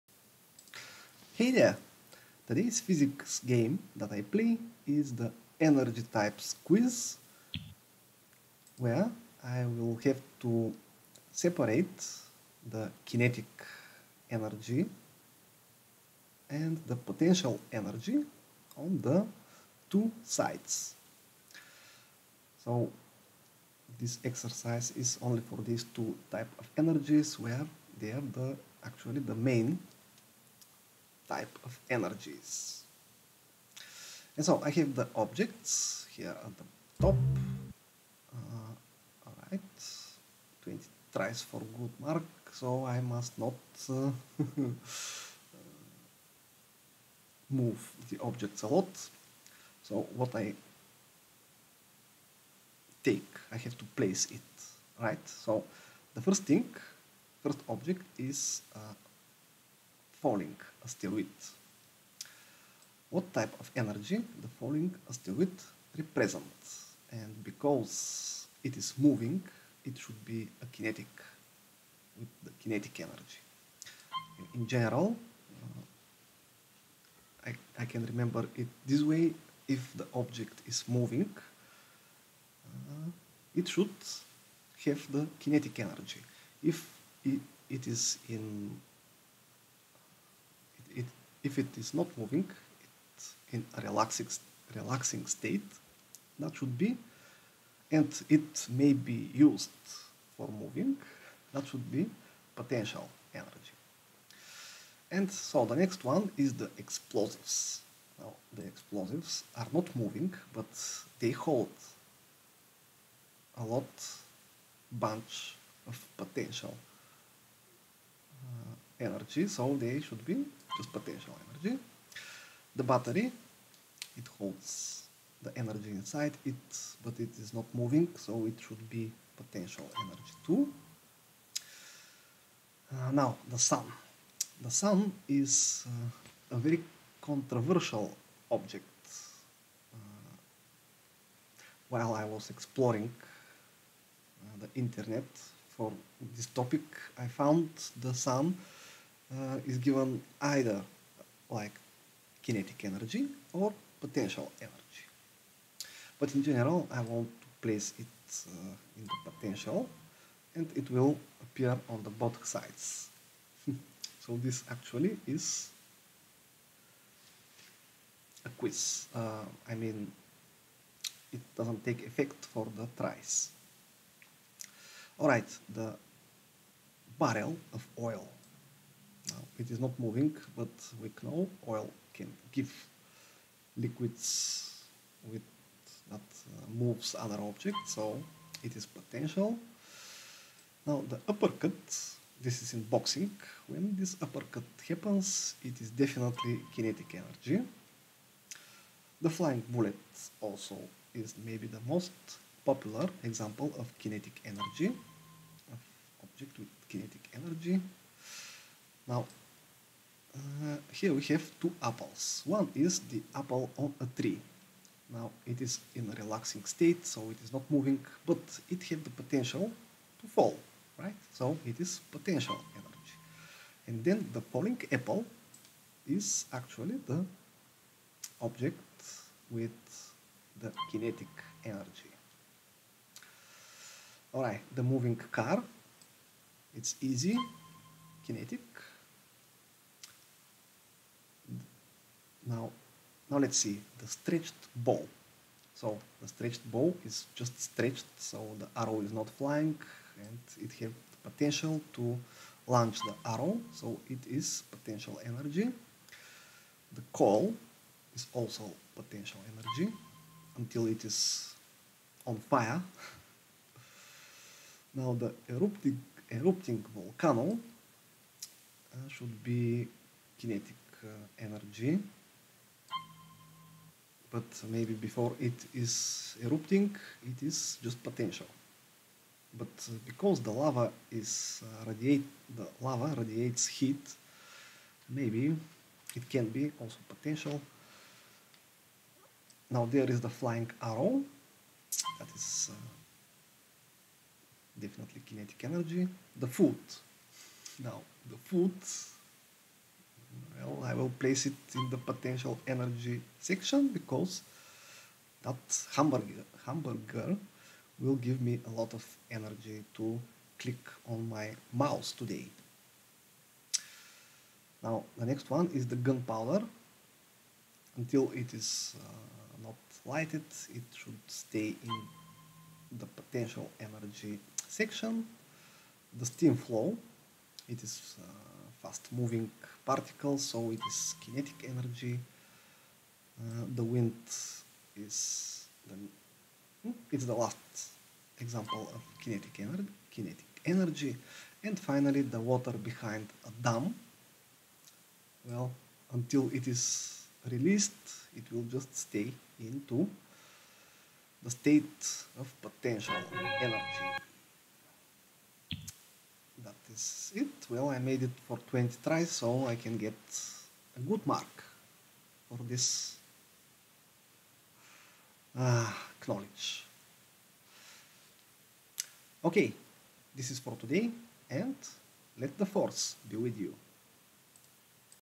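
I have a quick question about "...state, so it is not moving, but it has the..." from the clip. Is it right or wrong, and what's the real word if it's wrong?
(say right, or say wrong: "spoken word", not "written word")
right.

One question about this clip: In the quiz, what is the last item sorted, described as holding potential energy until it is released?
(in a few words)
Water behind a dam.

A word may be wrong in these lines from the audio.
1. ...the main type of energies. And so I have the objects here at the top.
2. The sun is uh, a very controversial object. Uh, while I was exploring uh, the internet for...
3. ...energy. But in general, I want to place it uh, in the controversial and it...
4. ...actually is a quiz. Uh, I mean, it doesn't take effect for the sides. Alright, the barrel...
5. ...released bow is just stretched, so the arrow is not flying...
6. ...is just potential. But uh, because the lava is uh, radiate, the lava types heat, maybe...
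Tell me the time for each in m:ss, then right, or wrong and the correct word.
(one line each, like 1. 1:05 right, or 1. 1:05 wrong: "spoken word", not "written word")
1. 0:29 right
2. 2:14 right
3. 2:34 wrong: "potential", not "controversial"
4. 2:44 wrong: "tries", not "sides"
5. 4:06 wrong: "stretched", not "released"
6. 4:37 wrong: "radiates", not "types".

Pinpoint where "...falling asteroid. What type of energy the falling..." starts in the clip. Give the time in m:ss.
1:00.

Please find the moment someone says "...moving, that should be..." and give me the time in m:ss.
1:40.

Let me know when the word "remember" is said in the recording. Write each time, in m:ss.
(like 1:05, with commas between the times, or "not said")
1:18.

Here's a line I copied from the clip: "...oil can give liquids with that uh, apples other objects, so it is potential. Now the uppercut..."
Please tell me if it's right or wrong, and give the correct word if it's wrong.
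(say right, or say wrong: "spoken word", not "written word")
wrong: "moves", not "apples".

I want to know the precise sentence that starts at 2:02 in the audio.
The battery, it holds the energy inside it, but it is not moving, so it should be potential energy too.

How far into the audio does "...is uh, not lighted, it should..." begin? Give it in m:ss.
5:18.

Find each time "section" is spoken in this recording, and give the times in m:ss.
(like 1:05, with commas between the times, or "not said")
5:03, 5:24.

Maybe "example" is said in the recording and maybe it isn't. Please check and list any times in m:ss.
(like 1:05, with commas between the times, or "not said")
3:23, 5:38.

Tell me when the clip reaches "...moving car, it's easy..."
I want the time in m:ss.
3:54.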